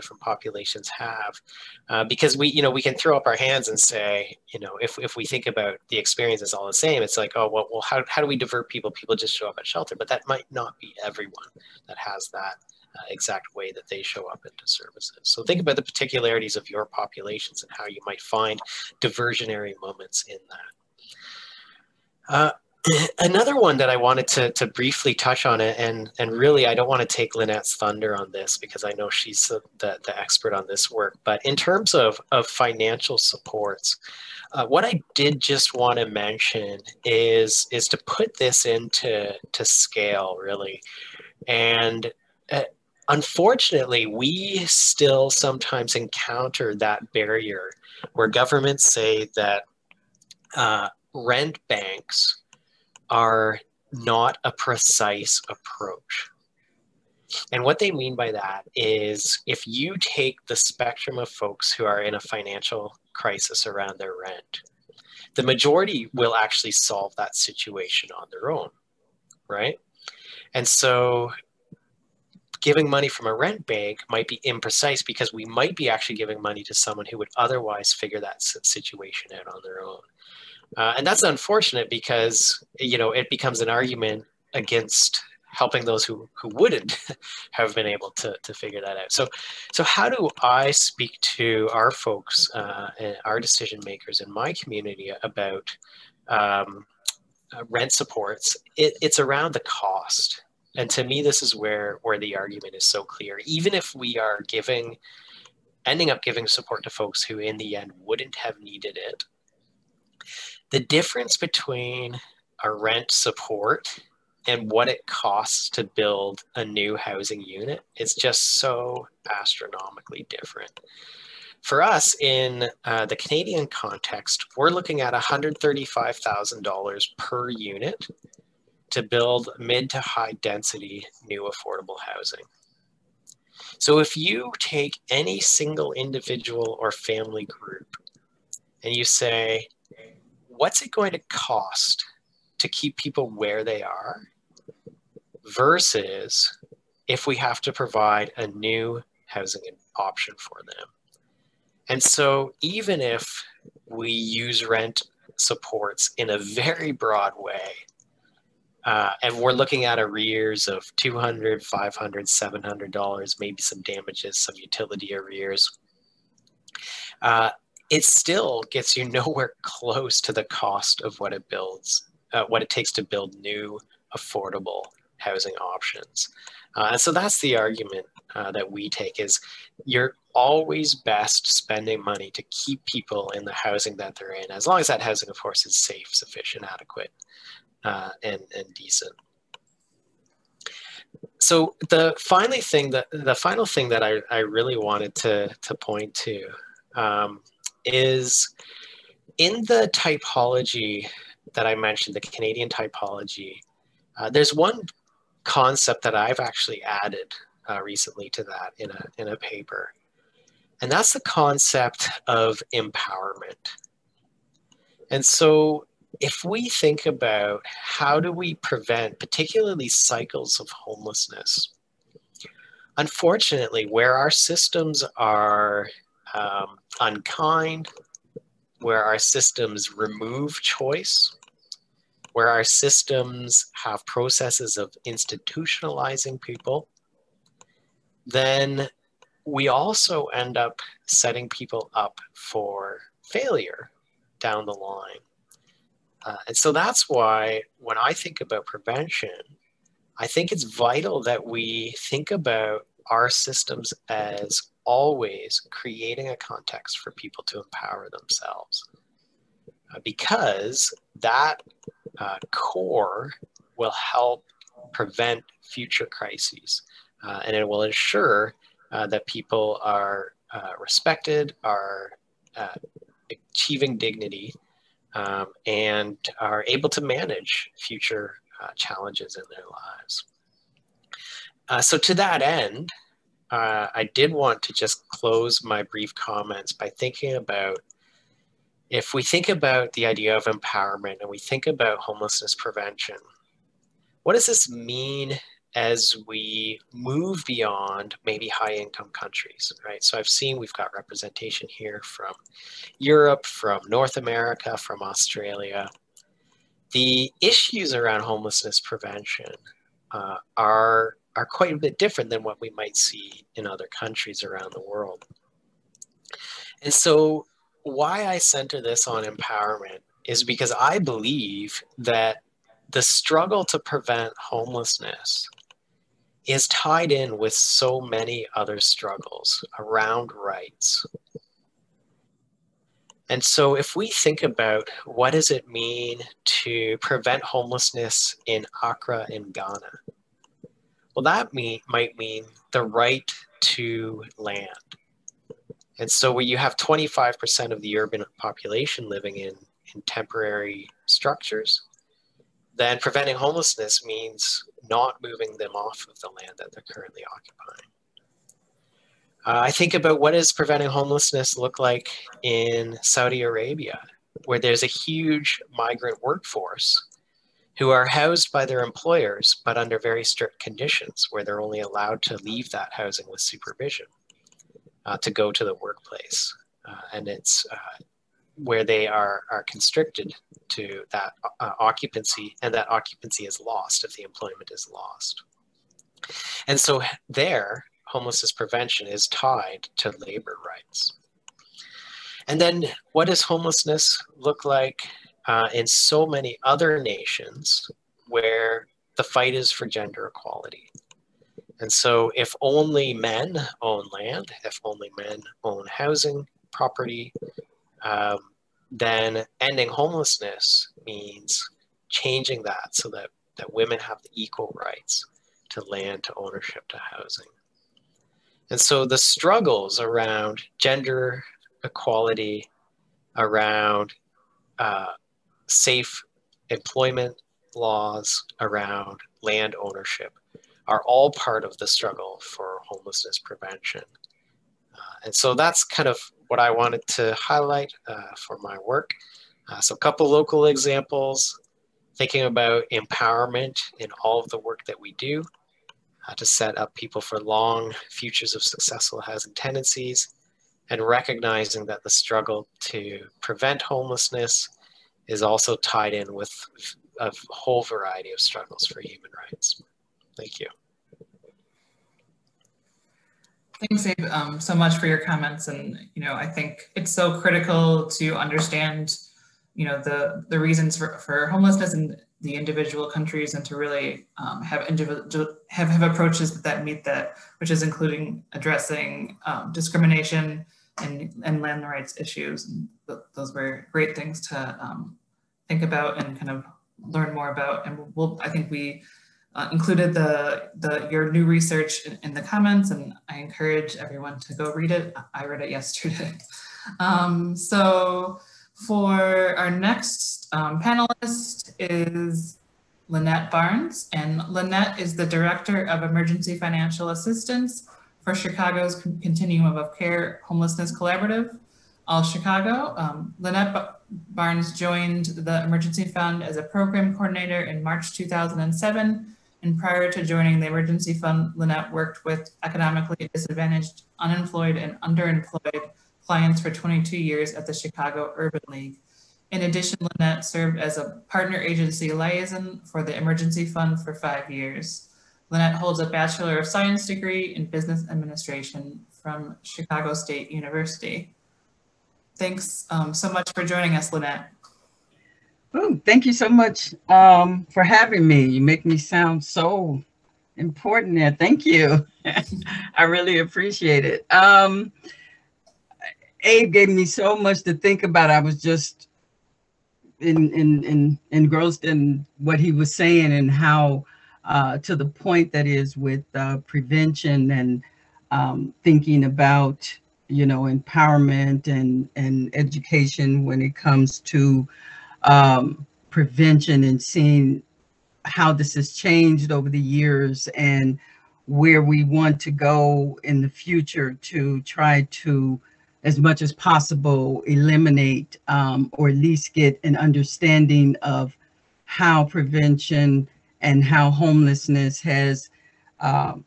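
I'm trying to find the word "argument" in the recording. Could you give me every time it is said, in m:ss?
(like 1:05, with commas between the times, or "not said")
1:23, 1:42, 2:57.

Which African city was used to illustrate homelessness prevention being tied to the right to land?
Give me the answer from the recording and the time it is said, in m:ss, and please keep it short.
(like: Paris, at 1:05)
Accra, at 5:38.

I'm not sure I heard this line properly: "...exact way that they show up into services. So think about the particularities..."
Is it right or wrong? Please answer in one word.
right.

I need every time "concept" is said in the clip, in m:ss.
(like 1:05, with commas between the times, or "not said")
3:25, 3:31.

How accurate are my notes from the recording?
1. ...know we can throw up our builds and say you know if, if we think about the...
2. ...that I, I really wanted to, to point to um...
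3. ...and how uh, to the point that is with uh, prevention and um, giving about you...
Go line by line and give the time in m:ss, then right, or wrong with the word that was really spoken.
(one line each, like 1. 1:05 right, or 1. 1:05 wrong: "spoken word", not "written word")
1. 0:02 wrong: "hands", not "builds"
2. 3:13 right
3. 9:23 wrong: "thinking", not "giving".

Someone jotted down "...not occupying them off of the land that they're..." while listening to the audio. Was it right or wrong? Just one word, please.
wrong.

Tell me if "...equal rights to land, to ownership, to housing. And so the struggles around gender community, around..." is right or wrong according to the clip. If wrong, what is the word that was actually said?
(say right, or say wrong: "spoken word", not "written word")
wrong: "equality", not "community".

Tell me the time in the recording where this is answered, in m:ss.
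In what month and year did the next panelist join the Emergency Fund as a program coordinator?
8:37.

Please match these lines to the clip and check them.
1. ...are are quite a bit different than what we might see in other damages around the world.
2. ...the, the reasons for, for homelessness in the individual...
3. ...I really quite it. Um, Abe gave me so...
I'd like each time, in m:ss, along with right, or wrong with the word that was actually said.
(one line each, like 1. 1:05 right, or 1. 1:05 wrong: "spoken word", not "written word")
1. 5:10 wrong: "countries", not "damages"
2. 7:50 right
3. 9:12 wrong: "appreciate", not "quite".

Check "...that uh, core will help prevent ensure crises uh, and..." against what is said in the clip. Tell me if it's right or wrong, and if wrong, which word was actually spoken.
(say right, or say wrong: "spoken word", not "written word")
wrong: "future", not "ensure".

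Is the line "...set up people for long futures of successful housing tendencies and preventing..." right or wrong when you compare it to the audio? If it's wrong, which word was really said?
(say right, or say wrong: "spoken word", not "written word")
wrong: "recognizing", not "preventing".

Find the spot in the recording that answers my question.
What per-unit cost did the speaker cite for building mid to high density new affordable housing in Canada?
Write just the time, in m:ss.
2:05.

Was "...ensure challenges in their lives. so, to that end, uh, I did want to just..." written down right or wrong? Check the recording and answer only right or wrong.
wrong.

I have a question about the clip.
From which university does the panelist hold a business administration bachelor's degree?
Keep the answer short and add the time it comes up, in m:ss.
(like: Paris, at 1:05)
Chicago State University, at 8:59.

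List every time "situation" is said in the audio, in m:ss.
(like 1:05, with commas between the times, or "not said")
1:07, 1:18.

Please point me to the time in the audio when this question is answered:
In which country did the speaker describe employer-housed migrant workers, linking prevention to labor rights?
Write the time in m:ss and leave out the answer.
6:03.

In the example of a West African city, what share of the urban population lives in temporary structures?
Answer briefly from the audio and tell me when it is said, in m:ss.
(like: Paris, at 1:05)
25%, at 5:46.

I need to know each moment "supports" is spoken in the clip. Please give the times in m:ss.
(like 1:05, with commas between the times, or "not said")
0:33, 1:37, 1:46, 1:53, 2:35.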